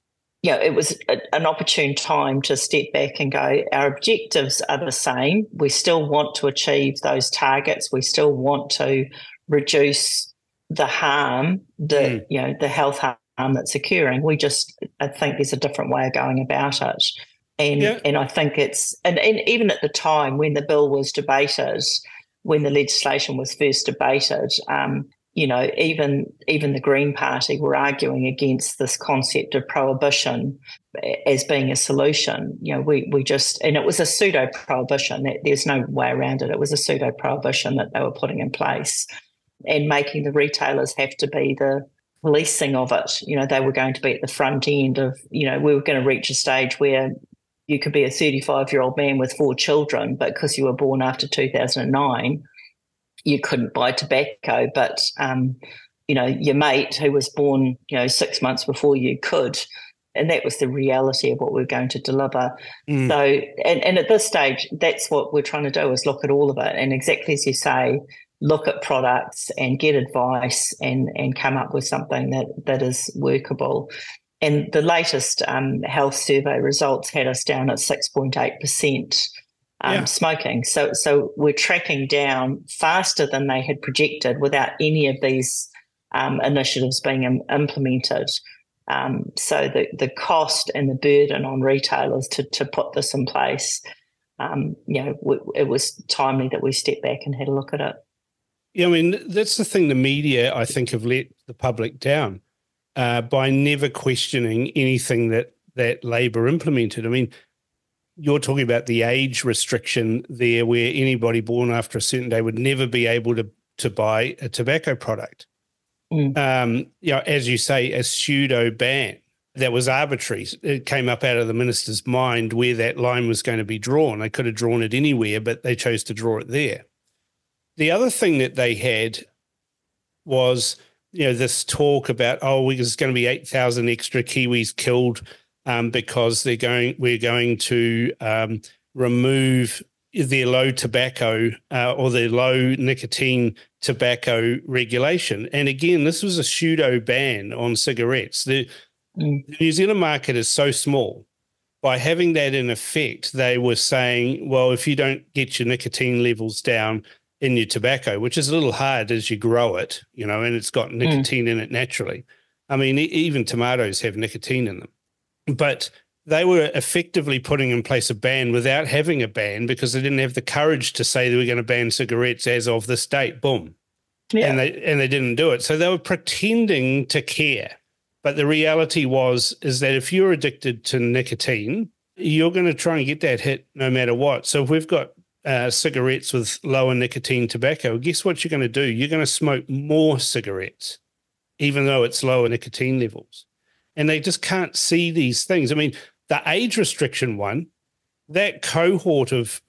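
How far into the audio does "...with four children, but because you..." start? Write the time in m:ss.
0:49.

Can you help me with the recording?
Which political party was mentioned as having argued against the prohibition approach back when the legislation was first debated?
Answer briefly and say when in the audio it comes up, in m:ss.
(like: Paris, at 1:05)
Green Party, at 0:26.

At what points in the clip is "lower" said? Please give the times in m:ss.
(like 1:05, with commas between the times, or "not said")
3:06, 3:12.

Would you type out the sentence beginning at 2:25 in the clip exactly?
And again, this was a pseudo ban on cigarettes.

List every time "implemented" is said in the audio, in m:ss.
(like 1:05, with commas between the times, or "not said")
1:27, 1:46.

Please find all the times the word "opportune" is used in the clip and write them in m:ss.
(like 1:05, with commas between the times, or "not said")
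0:01.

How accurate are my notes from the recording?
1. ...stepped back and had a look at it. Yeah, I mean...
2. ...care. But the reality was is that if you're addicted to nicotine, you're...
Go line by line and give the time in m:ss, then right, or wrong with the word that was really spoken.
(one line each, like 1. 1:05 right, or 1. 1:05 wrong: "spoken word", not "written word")
1. 1:36 right
2. 2:57 right.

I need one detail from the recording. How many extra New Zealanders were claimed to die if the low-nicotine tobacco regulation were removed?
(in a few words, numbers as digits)
8,000.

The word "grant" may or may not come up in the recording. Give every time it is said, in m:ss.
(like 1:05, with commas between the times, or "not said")
not said.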